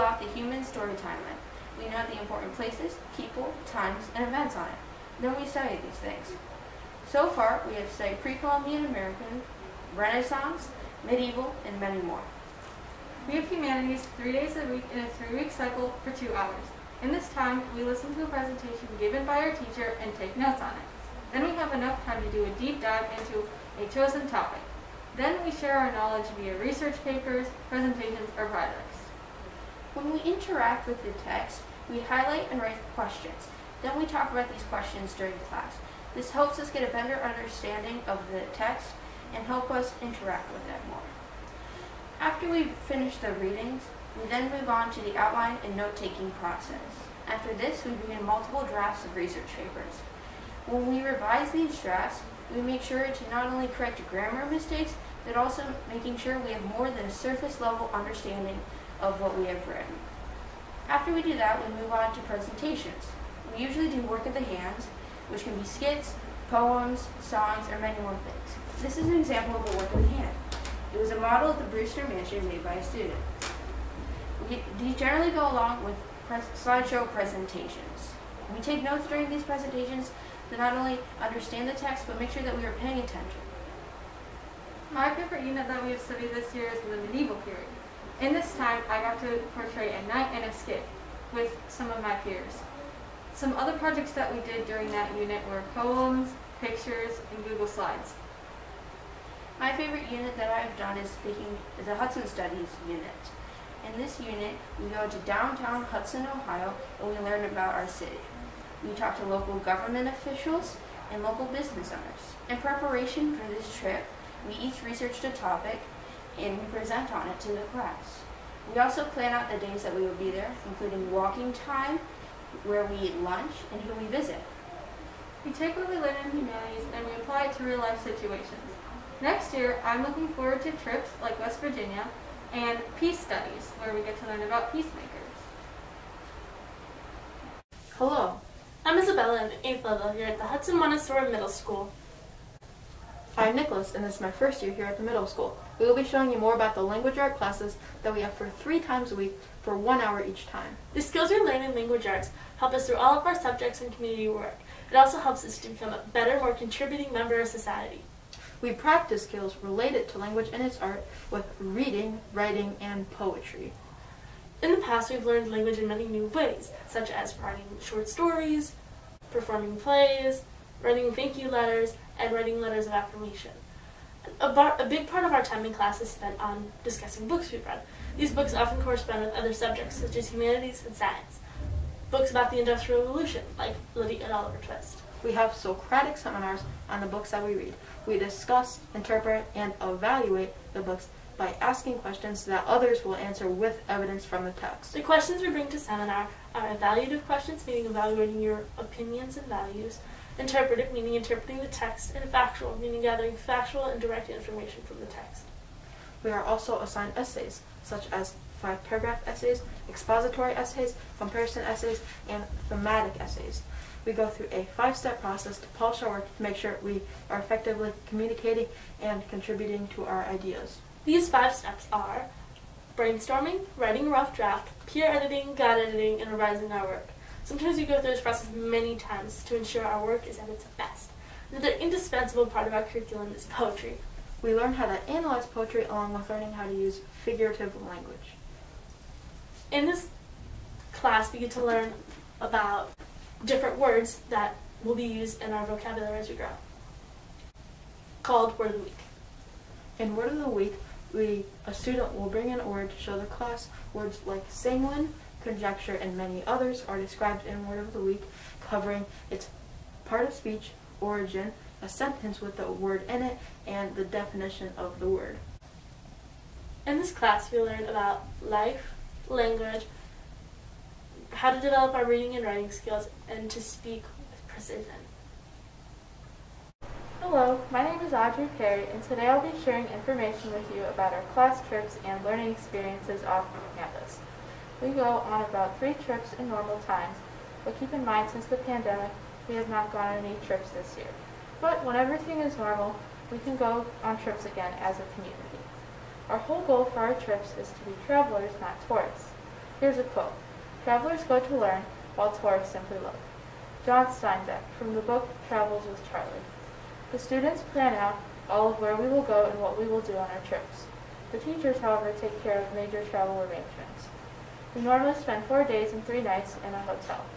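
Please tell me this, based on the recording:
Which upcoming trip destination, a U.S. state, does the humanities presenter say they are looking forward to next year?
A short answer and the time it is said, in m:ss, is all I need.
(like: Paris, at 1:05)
West Virginia, at 2:11.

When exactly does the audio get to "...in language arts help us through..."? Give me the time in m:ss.
2:31.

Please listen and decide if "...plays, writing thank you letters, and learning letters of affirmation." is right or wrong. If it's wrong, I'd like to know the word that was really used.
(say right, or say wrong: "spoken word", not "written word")
wrong: "writing", not "learning".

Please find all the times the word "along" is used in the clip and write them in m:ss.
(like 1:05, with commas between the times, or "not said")
1:15, 3:55.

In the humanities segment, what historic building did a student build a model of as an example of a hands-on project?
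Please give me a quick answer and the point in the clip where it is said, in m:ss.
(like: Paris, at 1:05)
Brewster Mansion, at 1:11.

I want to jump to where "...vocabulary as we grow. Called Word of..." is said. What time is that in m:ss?
4:05.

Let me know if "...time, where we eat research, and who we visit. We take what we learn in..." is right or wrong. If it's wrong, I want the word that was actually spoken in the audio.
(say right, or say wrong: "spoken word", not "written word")
wrong: "lunch", not "research".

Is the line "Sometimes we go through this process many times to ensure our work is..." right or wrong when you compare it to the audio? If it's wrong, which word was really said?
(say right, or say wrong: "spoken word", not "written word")
right.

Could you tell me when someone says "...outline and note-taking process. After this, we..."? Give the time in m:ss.
0:45.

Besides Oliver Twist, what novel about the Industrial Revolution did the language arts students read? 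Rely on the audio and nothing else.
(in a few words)
Lyddie.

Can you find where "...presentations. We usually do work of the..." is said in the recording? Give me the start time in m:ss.
1:02.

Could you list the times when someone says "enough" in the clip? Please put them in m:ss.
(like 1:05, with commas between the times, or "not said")
0:21.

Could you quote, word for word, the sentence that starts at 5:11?
The teachers, however, take care of major travel arrangements.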